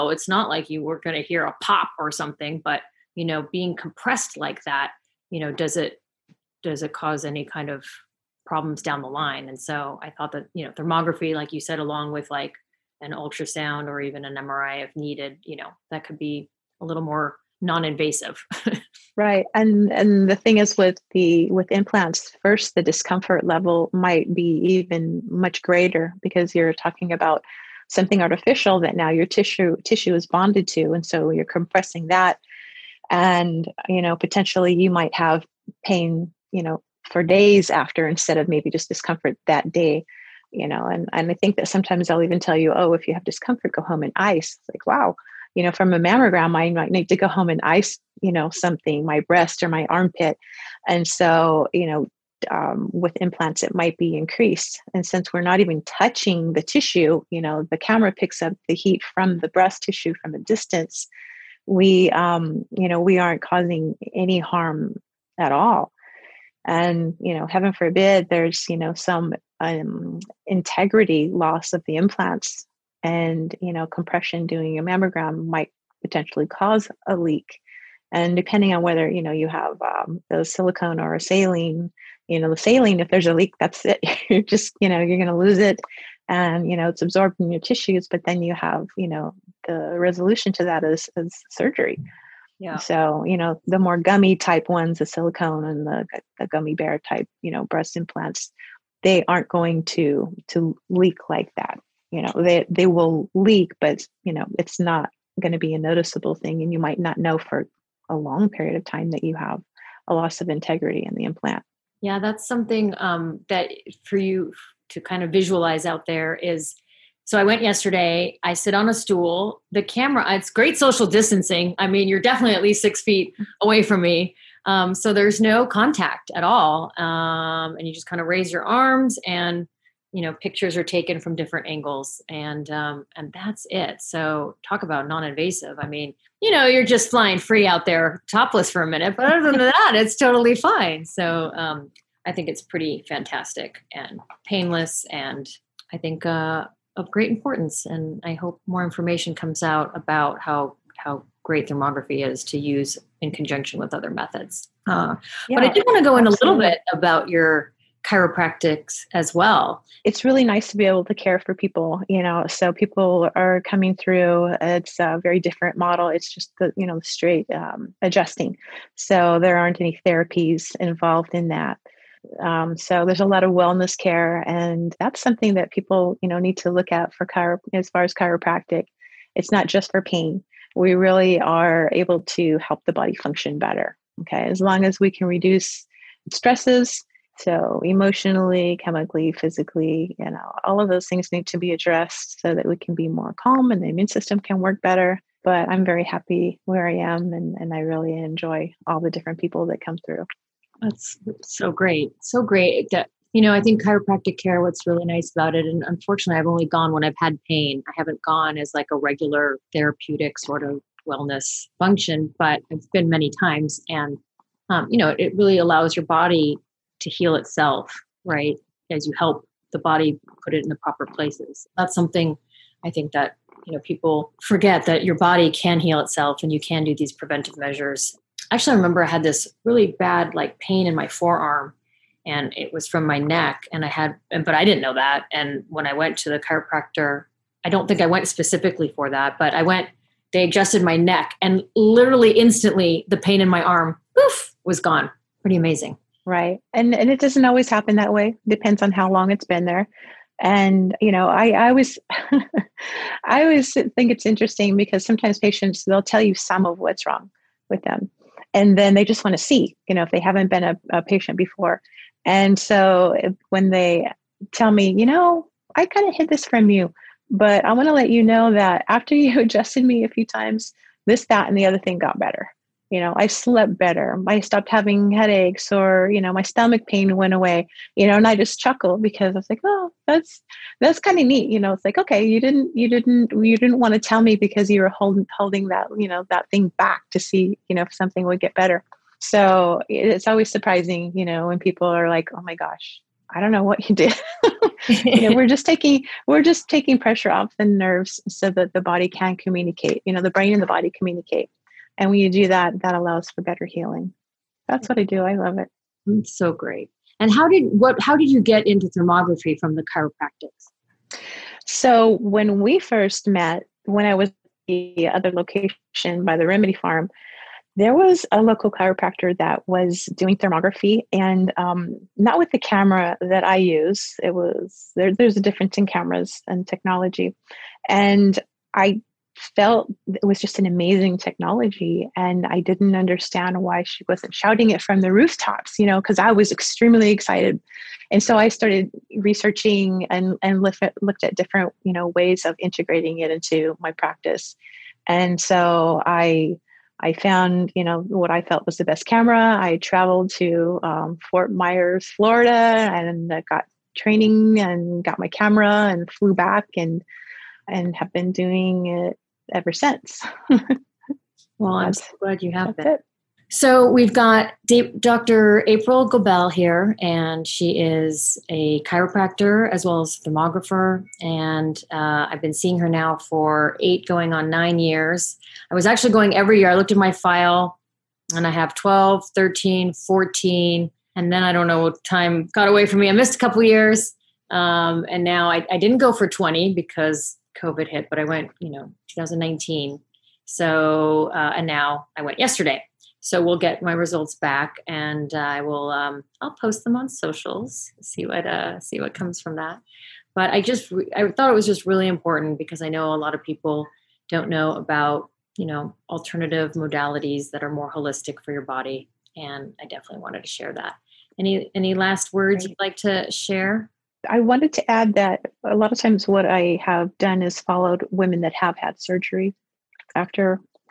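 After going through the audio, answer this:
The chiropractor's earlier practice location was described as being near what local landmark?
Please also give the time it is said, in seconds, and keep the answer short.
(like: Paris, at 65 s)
the remedy farm, at 316 s.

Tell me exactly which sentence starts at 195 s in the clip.
But I'm very happy where I am and, and I really enjoy all the different people that come through.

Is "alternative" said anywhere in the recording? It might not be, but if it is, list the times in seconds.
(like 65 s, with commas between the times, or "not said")
406 s.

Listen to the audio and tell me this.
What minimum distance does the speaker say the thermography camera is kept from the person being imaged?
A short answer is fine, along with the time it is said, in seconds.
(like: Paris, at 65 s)
6 feet, at 122 s.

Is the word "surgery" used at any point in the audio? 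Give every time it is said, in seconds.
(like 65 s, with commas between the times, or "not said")
91 s, 419 s.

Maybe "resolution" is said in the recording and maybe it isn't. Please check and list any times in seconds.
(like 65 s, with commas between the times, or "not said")
89 s.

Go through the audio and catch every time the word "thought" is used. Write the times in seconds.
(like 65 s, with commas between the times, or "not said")
10 s, 401 s.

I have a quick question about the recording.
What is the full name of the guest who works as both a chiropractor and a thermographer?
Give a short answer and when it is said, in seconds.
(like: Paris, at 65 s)
April Goebel, at 365 s.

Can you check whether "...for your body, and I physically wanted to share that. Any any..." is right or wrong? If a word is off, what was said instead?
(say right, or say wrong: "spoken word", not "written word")
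wrong: "definitely", not "physically".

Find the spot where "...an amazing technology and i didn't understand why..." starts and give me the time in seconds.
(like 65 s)
330 s.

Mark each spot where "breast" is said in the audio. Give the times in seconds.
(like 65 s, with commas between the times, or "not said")
49 s, 59 s, 97 s.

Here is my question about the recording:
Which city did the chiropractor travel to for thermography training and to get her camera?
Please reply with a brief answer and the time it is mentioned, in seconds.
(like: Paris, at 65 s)
Fort Myers, at 351 s.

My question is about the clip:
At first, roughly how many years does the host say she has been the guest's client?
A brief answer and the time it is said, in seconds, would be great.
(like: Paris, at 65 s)
8, at 373 s.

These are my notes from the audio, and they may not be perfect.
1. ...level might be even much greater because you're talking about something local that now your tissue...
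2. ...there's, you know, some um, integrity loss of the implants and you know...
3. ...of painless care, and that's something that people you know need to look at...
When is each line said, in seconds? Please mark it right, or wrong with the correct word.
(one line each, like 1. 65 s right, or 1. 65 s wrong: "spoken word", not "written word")
1. 23 s wrong: "artificial", not "local"
2. 68 s right
3. 173 s wrong: "wellness", not "painless".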